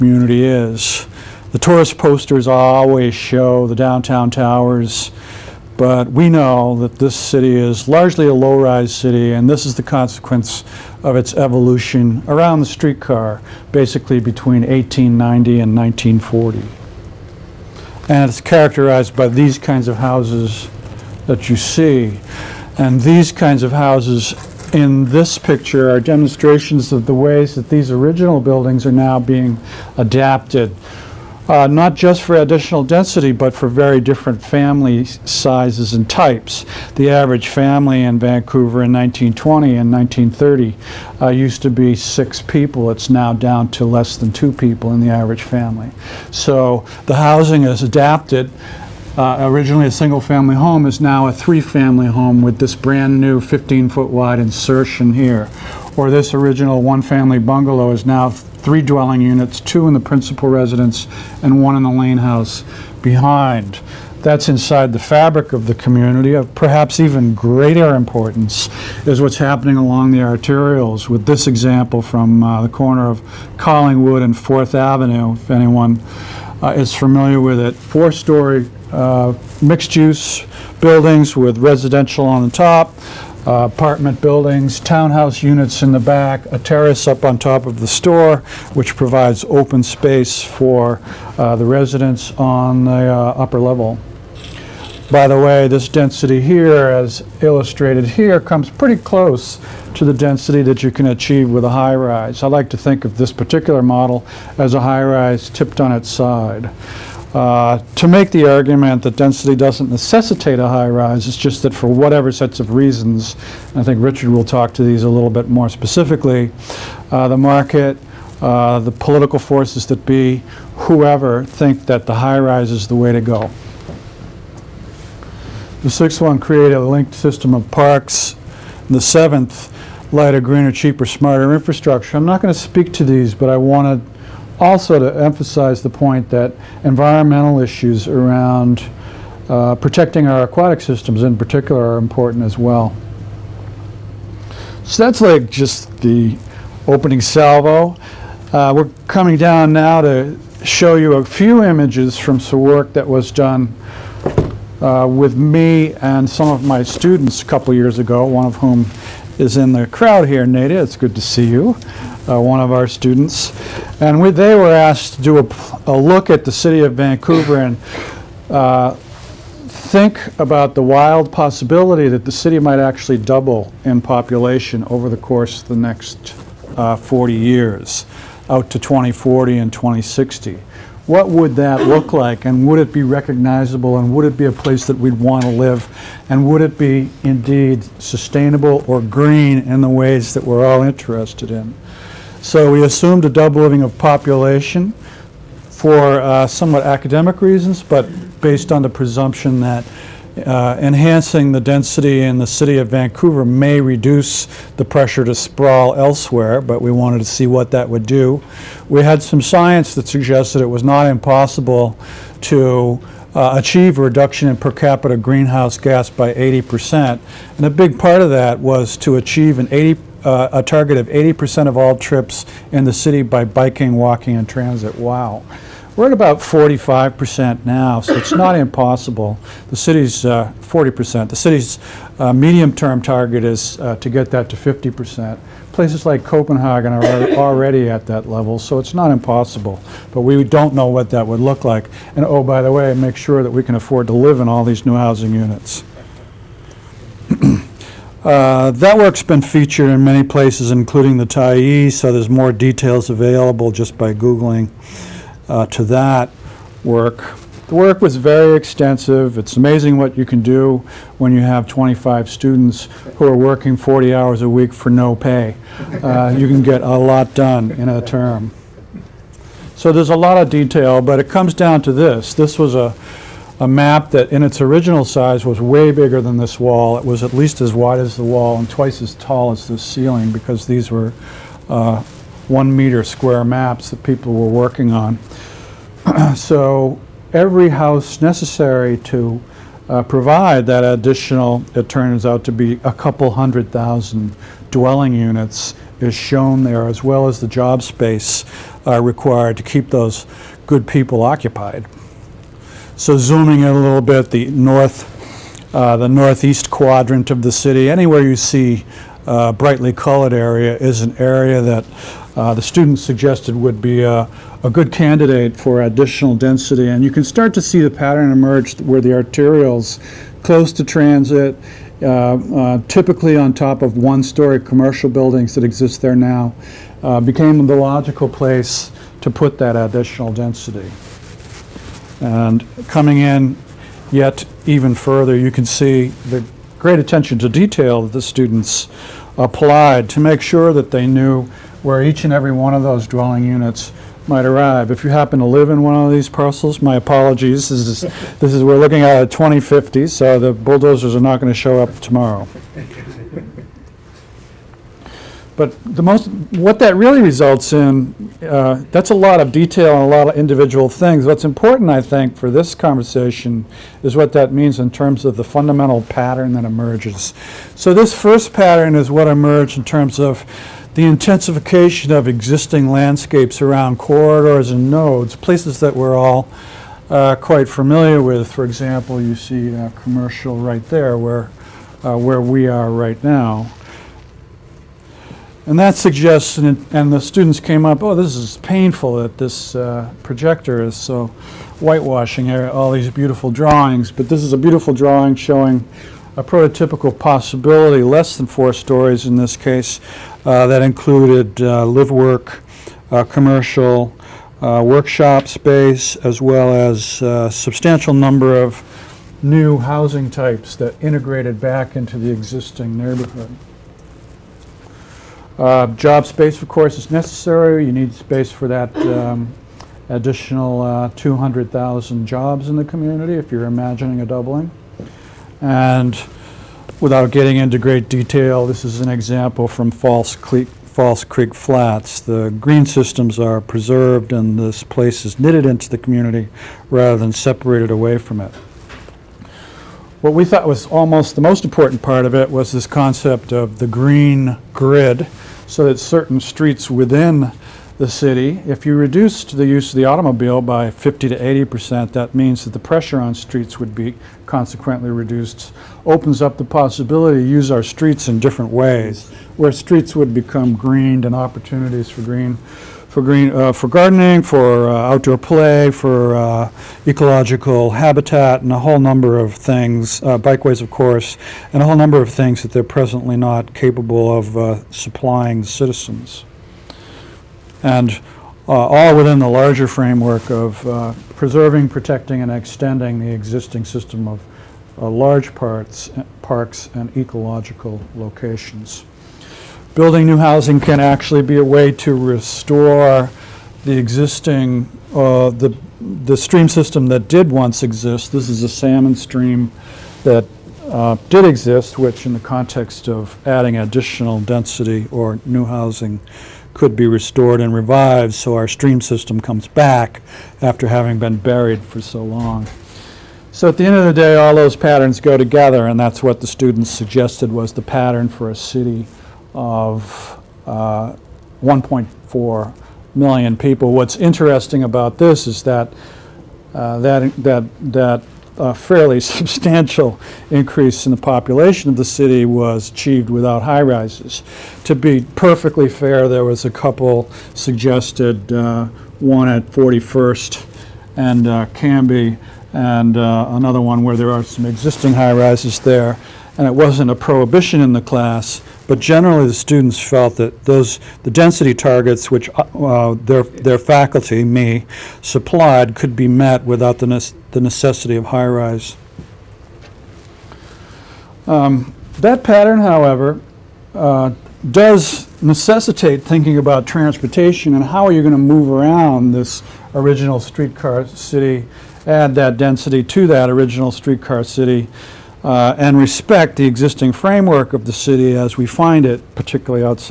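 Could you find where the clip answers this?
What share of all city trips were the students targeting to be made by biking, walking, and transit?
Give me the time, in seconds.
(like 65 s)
221 s.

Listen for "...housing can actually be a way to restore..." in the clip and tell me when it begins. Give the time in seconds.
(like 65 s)
490 s.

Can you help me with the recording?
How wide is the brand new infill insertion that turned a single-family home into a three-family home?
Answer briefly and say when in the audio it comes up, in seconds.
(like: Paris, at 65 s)
15-foot, at 53 s.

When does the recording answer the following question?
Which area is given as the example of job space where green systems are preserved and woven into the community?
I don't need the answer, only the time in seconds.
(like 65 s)
430 s.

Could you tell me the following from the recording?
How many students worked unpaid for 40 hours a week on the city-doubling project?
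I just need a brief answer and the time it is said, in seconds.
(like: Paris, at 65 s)
25, at 261 s.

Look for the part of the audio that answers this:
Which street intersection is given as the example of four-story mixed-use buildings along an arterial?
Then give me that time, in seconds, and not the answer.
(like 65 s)
73 s.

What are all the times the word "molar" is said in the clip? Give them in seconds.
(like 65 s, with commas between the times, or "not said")
not said.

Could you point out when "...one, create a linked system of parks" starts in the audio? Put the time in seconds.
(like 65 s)
126 s.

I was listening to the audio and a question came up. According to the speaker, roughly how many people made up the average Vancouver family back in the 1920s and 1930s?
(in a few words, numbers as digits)
6.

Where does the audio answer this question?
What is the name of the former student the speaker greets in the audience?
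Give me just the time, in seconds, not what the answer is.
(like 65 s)
160 s.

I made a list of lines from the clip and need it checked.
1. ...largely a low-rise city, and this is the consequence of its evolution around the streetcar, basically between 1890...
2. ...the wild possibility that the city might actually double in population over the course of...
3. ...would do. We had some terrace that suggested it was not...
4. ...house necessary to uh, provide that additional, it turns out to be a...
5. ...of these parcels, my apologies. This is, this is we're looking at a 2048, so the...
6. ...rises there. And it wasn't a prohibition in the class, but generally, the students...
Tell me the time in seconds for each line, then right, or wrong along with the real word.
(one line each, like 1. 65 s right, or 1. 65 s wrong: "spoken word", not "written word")
1. 7 s right
2. 170 s right
3. 207 s wrong: "science", not "terrace"
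4. 287 s right
5. 345 s wrong: "2050", not "2048"
6. 545 s right.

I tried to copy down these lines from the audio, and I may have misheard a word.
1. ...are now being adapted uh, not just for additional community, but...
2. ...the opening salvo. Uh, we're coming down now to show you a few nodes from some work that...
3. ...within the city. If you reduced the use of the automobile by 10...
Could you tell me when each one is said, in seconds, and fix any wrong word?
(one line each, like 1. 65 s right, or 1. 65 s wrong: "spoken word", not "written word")
1. 28 s wrong: "density", not "community"
2. 145 s wrong: "images", not "nodes"
3. 446 s wrong: "50", not "10".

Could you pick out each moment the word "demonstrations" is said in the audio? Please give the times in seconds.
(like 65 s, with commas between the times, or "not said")
26 s.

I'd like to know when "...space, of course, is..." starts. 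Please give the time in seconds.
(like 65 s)
416 s.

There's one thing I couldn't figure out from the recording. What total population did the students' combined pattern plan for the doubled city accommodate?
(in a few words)
1.4 million.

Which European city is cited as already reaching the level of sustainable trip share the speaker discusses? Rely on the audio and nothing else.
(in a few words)
Copenhagen.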